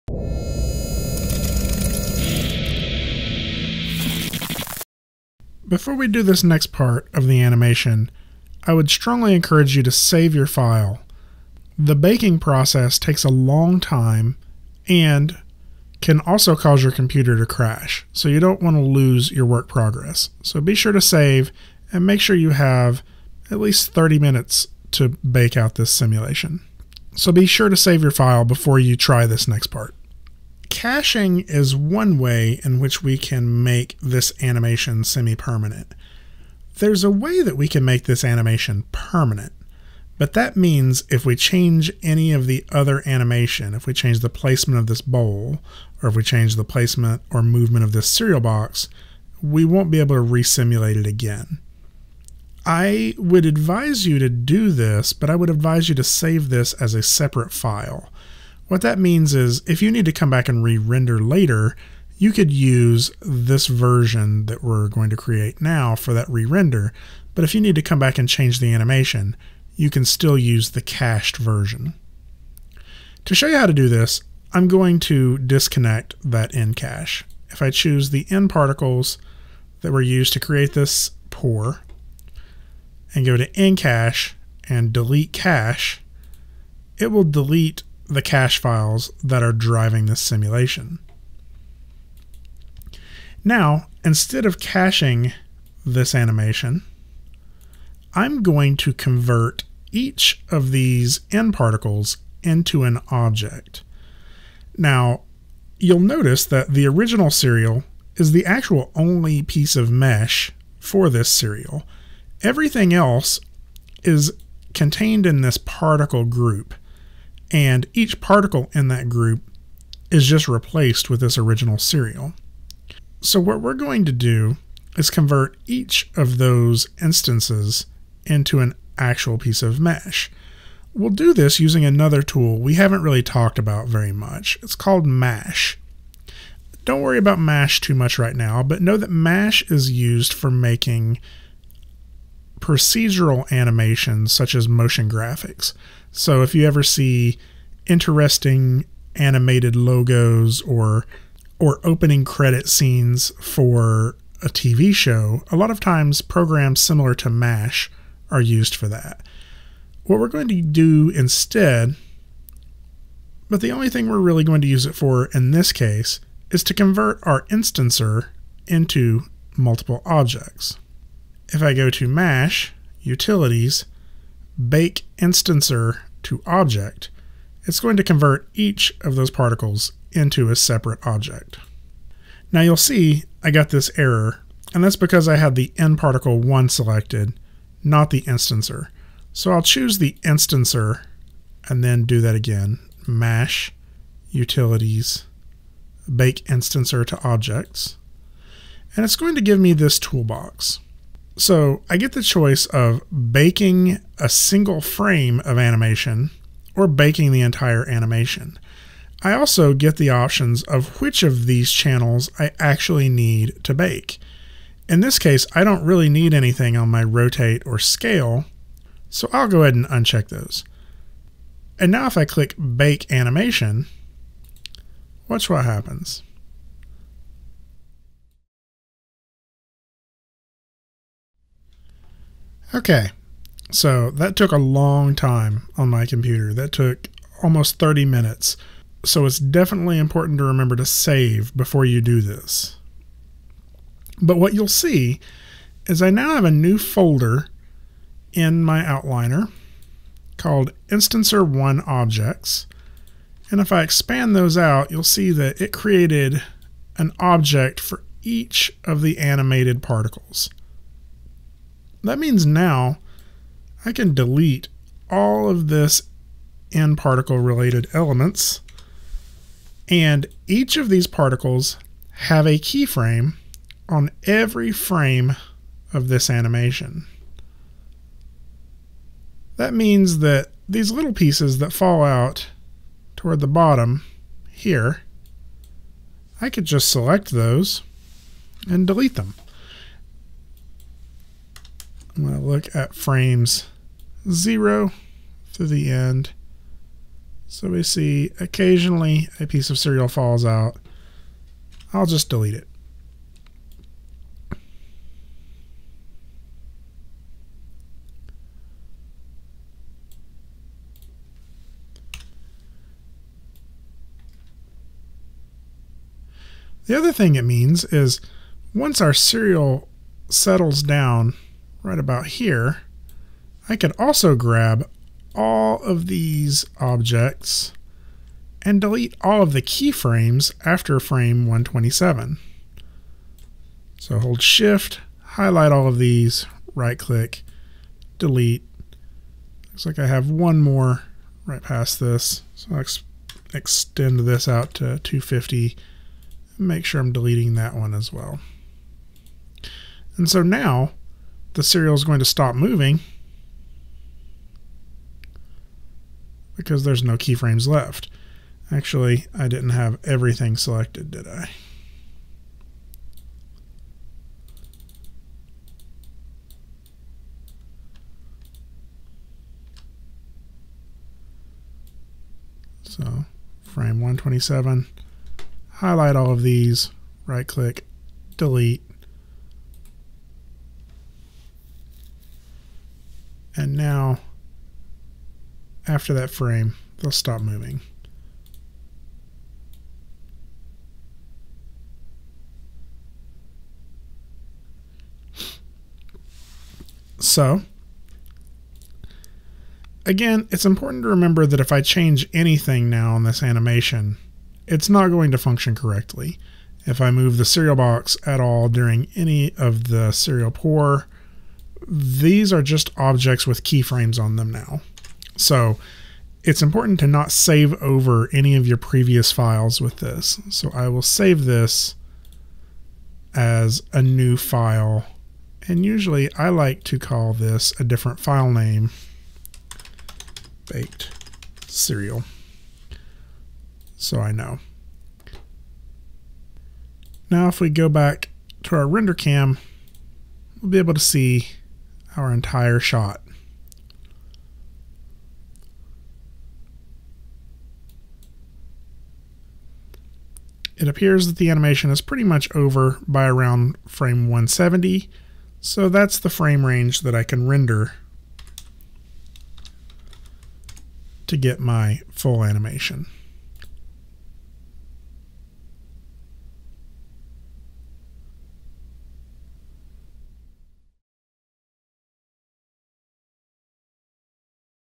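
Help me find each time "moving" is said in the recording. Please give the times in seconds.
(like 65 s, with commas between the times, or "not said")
352 s, 387 s.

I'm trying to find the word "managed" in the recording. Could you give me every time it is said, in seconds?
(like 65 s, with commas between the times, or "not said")
not said.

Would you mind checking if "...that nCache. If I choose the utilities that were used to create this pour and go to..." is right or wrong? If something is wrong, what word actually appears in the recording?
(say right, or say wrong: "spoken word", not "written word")
wrong: "nParticles", not "utilities".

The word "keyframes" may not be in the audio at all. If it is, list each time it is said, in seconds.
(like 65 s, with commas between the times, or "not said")
272 s, 329 s, 357 s, 413 s.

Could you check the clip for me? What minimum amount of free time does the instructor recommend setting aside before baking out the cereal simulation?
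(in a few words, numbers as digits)
30 minutes.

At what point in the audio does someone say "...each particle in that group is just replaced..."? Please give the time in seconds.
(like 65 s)
117 s.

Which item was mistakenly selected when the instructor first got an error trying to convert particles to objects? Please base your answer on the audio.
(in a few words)
nParticle 1.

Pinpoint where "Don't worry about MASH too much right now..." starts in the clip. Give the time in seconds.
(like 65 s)
136 s.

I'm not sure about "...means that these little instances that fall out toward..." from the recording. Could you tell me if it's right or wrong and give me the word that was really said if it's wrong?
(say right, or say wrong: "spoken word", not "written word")
wrong: "pieces", not "instances".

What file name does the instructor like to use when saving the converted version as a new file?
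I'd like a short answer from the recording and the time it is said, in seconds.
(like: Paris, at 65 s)
baked cereal, at 430 s.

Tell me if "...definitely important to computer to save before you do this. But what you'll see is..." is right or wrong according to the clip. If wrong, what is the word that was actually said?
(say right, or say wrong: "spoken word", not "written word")
wrong: "remember", not "computer".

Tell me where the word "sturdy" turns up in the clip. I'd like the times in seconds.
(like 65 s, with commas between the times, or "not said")
not said.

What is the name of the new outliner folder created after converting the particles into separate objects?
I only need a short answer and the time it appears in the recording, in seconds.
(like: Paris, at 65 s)
Instancer 1 Objects, at 250 s.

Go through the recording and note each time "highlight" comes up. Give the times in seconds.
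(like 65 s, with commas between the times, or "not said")
335 s, 375 s.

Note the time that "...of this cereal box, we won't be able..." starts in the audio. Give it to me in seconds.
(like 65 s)
47 s.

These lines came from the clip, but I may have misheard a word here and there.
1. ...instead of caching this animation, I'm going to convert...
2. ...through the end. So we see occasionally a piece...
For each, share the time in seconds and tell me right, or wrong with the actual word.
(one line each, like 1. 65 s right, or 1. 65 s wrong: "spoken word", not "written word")
1. 94 s right
2. 295 s right.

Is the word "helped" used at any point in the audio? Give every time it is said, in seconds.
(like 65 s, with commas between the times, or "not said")
not said.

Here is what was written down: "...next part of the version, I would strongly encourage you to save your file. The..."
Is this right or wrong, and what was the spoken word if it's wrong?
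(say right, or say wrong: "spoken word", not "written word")
wrong: "animation", not "version".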